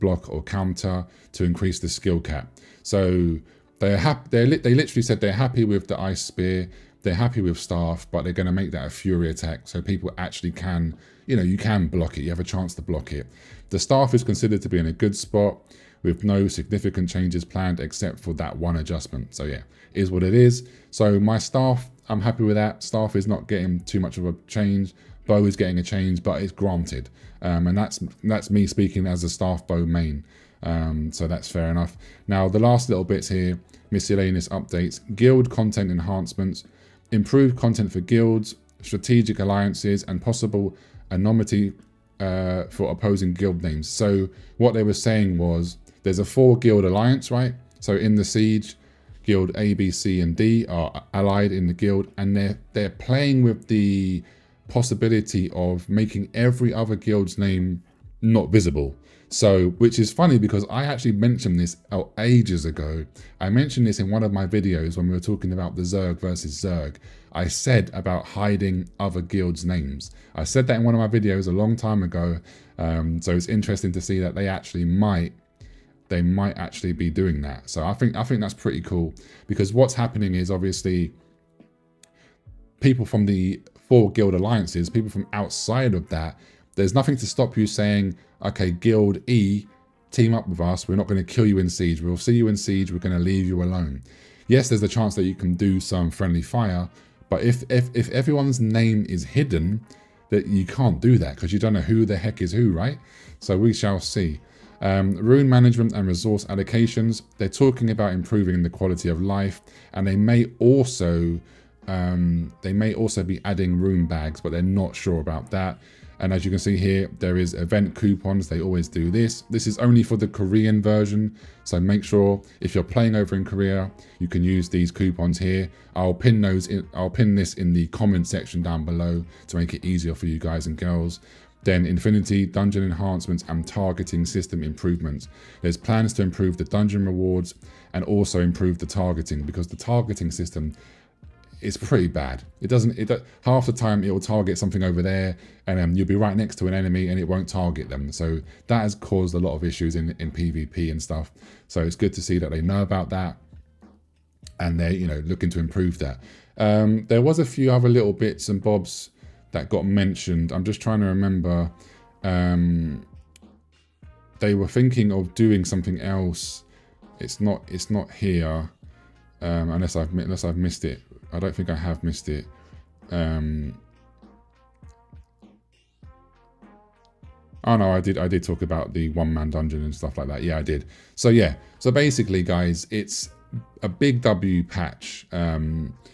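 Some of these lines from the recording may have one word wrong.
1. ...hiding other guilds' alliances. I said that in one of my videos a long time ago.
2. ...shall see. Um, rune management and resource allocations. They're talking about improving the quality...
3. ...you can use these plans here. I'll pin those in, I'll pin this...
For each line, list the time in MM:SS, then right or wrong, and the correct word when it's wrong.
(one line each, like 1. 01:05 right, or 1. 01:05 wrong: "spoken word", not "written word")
1. 01:08 wrong: "names", not "alliances"
2. 01:43 right
3. 02:04 wrong: "coupons", not "plans".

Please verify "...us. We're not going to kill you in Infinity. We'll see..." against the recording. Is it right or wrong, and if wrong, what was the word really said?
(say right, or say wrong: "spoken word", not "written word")
wrong: "Siege", not "Infinity".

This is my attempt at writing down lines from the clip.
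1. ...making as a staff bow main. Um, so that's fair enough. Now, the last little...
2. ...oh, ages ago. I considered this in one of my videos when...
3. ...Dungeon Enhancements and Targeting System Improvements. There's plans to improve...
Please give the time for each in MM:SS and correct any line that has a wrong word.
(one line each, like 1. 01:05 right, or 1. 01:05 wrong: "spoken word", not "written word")
1. 00:28 wrong: "speaking", not "making"
2. 01:01 wrong: "mentioned", not "considered"
3. 02:12 right.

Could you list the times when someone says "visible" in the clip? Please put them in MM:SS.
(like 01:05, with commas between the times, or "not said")
00:58.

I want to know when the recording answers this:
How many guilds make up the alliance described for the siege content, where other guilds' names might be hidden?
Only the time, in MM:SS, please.
00:46.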